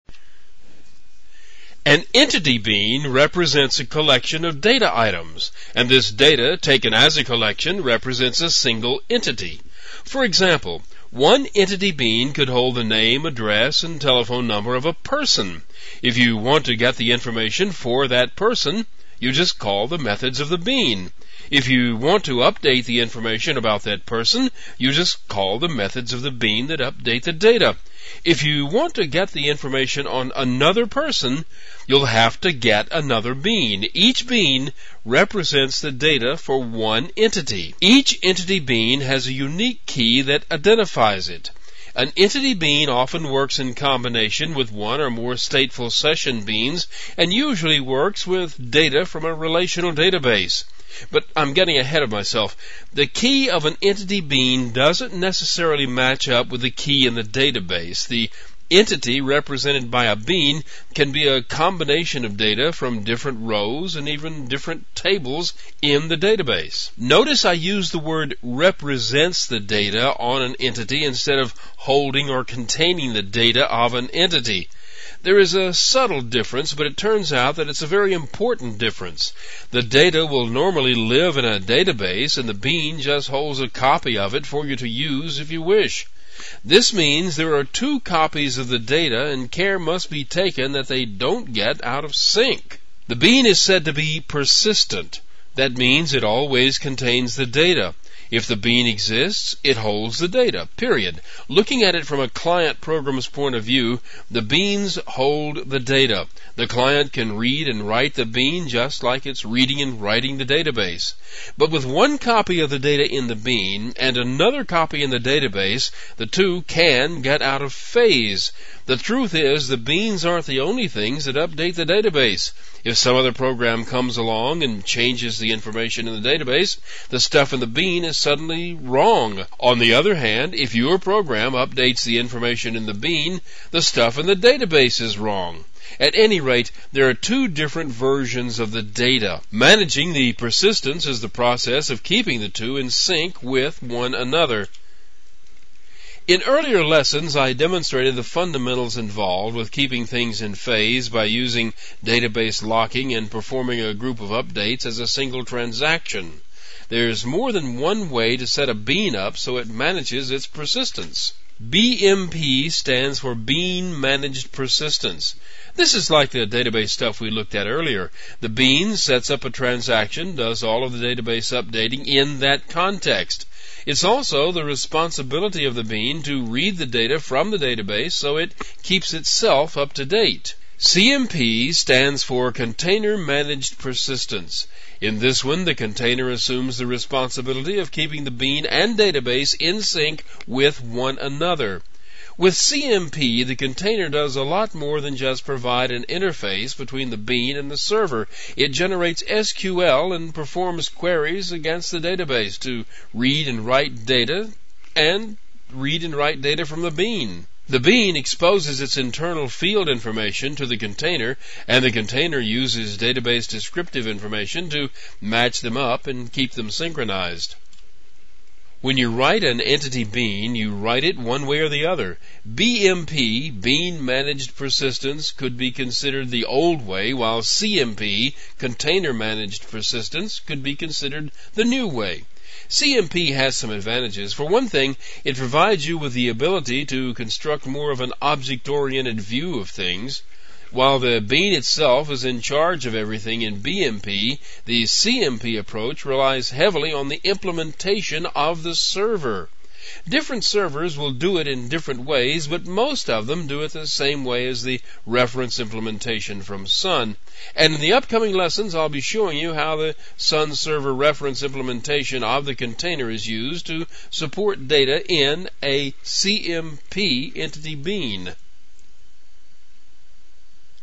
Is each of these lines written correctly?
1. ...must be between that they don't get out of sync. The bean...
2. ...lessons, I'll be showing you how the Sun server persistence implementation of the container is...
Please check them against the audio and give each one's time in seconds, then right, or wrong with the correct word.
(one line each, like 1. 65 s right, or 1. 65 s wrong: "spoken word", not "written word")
1. 89 s wrong: "taken", not "between"
2. 258 s wrong: "reference", not "persistence".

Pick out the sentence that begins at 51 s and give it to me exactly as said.
But I'm getting ahead of myself.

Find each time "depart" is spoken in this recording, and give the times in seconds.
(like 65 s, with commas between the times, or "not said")
not said.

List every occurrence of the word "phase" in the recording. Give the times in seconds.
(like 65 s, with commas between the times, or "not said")
117 s, 150 s.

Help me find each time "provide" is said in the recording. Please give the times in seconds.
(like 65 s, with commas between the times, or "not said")
195 s, 235 s.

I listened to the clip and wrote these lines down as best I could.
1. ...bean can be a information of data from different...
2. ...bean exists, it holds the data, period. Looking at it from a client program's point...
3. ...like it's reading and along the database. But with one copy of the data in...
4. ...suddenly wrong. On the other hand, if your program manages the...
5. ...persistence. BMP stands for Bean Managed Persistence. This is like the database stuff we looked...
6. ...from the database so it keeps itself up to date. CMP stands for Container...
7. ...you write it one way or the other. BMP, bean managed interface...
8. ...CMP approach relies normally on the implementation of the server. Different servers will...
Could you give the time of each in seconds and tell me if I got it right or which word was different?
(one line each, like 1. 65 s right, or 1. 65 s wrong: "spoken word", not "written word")
1. 60 s wrong: "combination", not "information"
2. 98 s right
3. 109 s wrong: "writing", not "along"
4. 128 s wrong: "updates", not "manages"
5. 160 s right
6. 177 s right
7. 220 s wrong: "persistence", not "interface"
8. 244 s wrong: "heavily", not "normally".